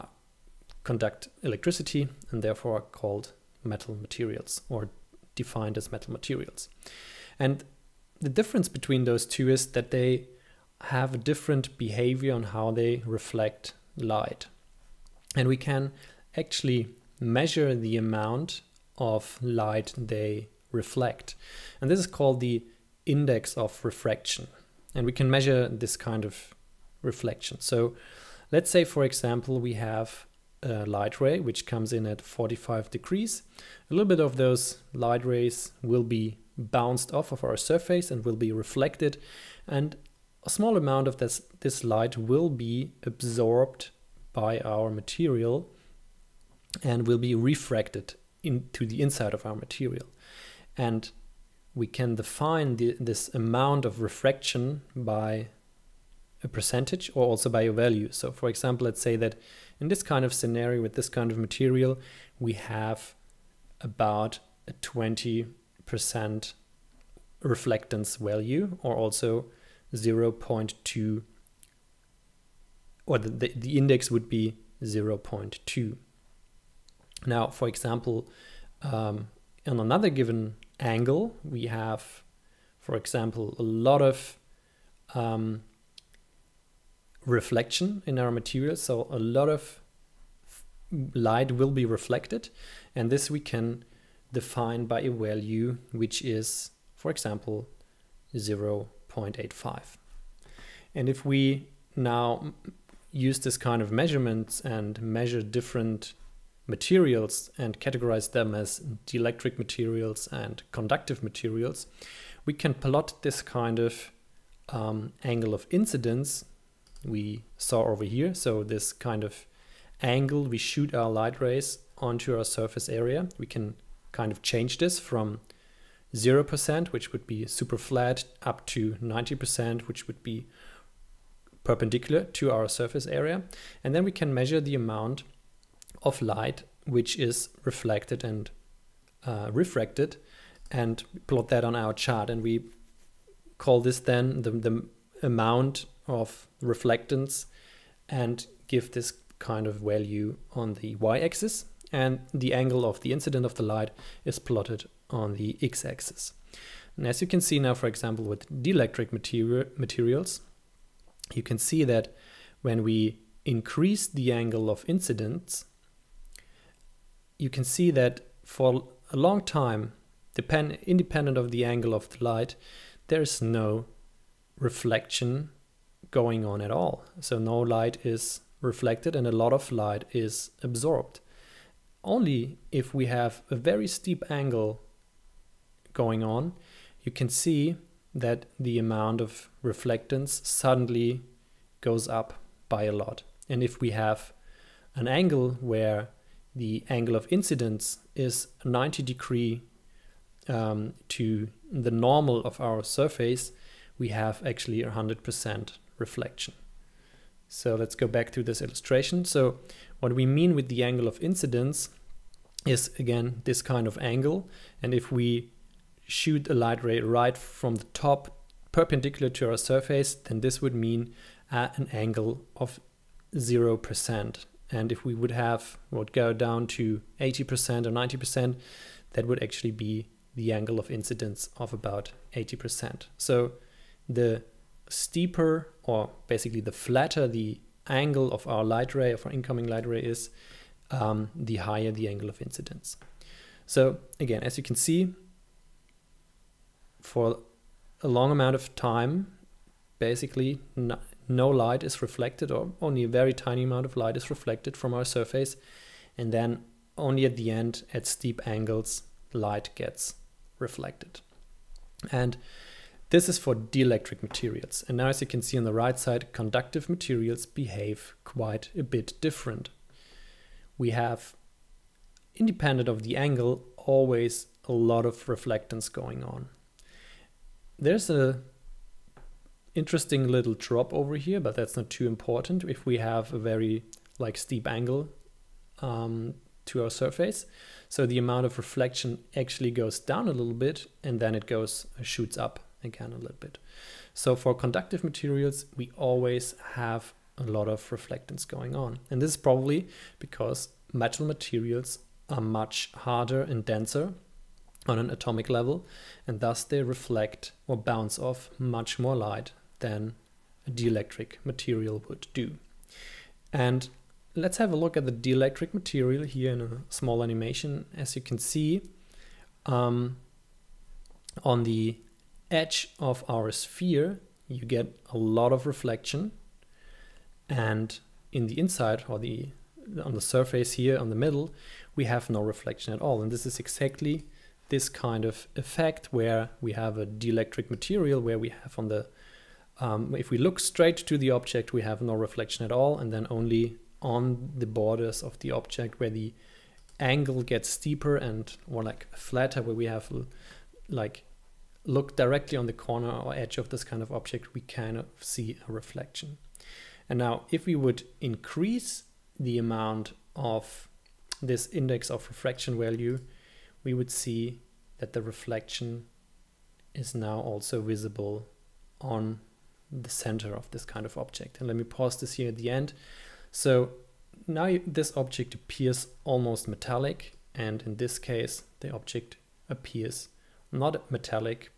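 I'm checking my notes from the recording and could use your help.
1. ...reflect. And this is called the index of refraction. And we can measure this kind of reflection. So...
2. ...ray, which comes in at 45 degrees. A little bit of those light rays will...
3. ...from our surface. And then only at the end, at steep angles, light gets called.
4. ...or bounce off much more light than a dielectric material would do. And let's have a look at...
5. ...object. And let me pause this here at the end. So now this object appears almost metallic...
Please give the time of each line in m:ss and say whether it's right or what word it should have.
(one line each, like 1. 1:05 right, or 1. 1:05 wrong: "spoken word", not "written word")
1. 0:20 right
2. 0:31 right
3. 4:14 wrong: "reflected", not "called"
4. 5:07 right
5. 6:11 right.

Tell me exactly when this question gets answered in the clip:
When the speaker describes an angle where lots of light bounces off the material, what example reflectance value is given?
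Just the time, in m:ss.
1:38.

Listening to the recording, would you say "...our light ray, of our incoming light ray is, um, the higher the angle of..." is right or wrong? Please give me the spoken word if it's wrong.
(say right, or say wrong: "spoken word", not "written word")
right.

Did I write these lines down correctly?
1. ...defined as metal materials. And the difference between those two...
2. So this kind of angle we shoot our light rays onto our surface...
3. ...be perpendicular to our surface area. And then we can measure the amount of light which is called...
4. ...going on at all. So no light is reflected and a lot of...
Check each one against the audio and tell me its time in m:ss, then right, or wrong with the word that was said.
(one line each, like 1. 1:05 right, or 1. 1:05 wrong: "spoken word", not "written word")
1. 0:05 right
2. 1:58 right
3. 2:10 wrong: "reflected", not "called"
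4. 2:56 right.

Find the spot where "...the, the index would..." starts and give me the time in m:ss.
1:13.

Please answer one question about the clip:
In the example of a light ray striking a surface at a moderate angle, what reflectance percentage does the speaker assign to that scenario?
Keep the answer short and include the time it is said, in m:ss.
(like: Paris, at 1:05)
20%, at 1:04.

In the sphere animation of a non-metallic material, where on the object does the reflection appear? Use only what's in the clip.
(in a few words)
on the edge.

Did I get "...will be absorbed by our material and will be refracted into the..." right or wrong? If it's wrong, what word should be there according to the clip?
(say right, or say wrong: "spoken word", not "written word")
right.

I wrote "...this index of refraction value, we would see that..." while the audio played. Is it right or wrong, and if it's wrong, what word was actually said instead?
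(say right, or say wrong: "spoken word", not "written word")
right.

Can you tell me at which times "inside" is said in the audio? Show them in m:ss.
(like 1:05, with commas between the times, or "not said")
0:49, 5:28.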